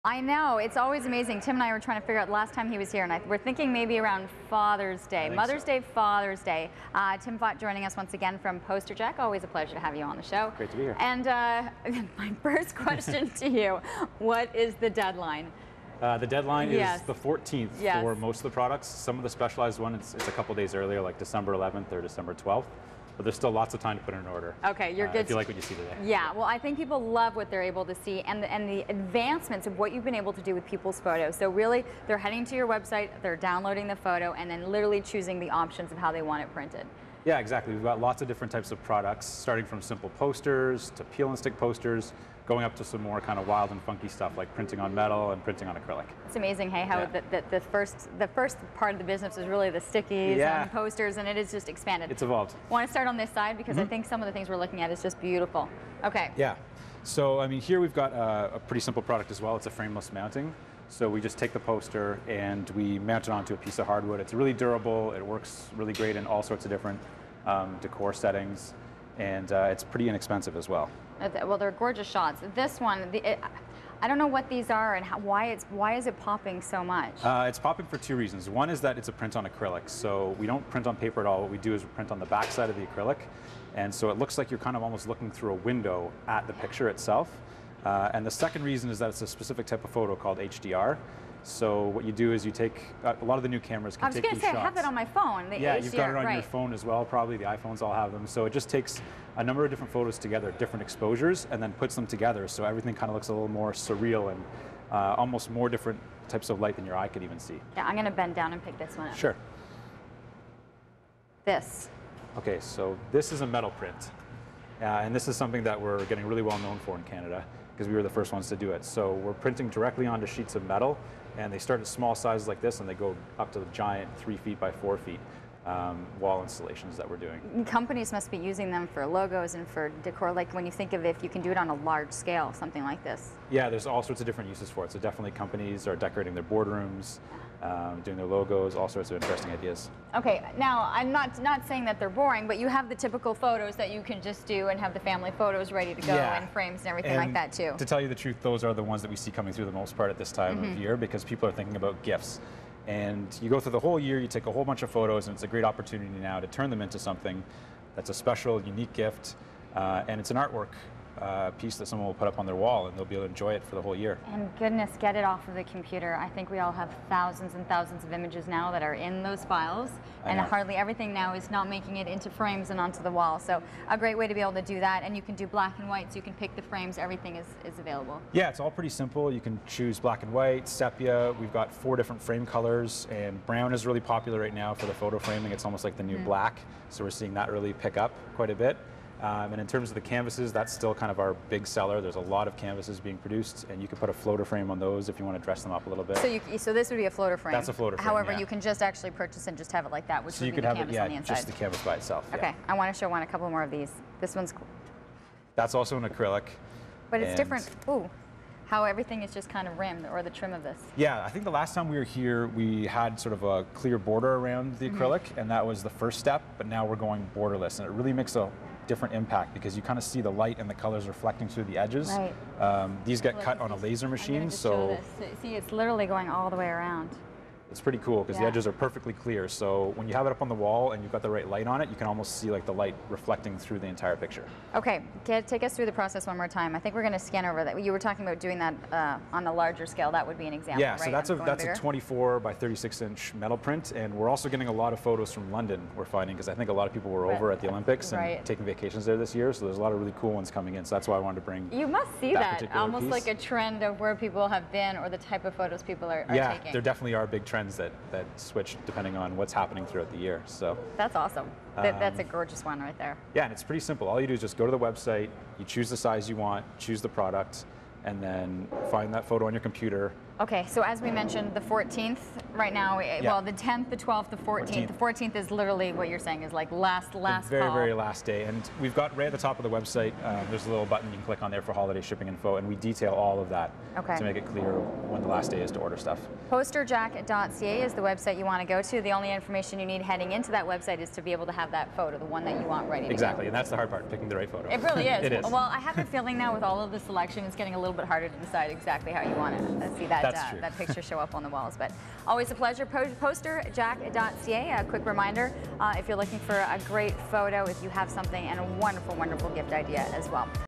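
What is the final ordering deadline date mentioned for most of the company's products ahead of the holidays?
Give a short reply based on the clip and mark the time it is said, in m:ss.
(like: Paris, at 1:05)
the 14th, at 0:17.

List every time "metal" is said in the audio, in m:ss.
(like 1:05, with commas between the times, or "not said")
0:44, 1:53, 2:00, 4:03.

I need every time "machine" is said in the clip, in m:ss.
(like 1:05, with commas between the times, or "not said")
3:44.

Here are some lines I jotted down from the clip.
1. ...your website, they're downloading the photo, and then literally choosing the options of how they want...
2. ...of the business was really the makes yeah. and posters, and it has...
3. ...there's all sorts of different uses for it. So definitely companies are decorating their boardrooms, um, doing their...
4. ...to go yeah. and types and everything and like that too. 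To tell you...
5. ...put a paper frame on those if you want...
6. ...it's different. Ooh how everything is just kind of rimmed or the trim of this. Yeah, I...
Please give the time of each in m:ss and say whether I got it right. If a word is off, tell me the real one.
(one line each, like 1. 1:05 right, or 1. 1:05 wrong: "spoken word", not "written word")
1. 0:32 right
2. 0:48 wrong: "stickies", not "makes"
3. 2:13 right
4. 2:25 wrong: "frames", not "types"
5. 3:13 wrong: "floater", not "paper"
6. 3:27 right.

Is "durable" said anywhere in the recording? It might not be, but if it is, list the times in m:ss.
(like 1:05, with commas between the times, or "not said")
1:04.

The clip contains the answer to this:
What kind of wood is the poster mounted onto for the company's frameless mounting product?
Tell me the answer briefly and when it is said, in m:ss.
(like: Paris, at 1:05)
hardwood, at 1:03.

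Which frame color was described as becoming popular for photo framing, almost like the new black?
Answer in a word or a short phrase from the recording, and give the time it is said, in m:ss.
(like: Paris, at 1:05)
brown, at 3:03.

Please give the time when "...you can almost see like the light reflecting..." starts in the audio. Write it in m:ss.
3:51.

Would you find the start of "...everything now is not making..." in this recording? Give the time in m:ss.
2:50.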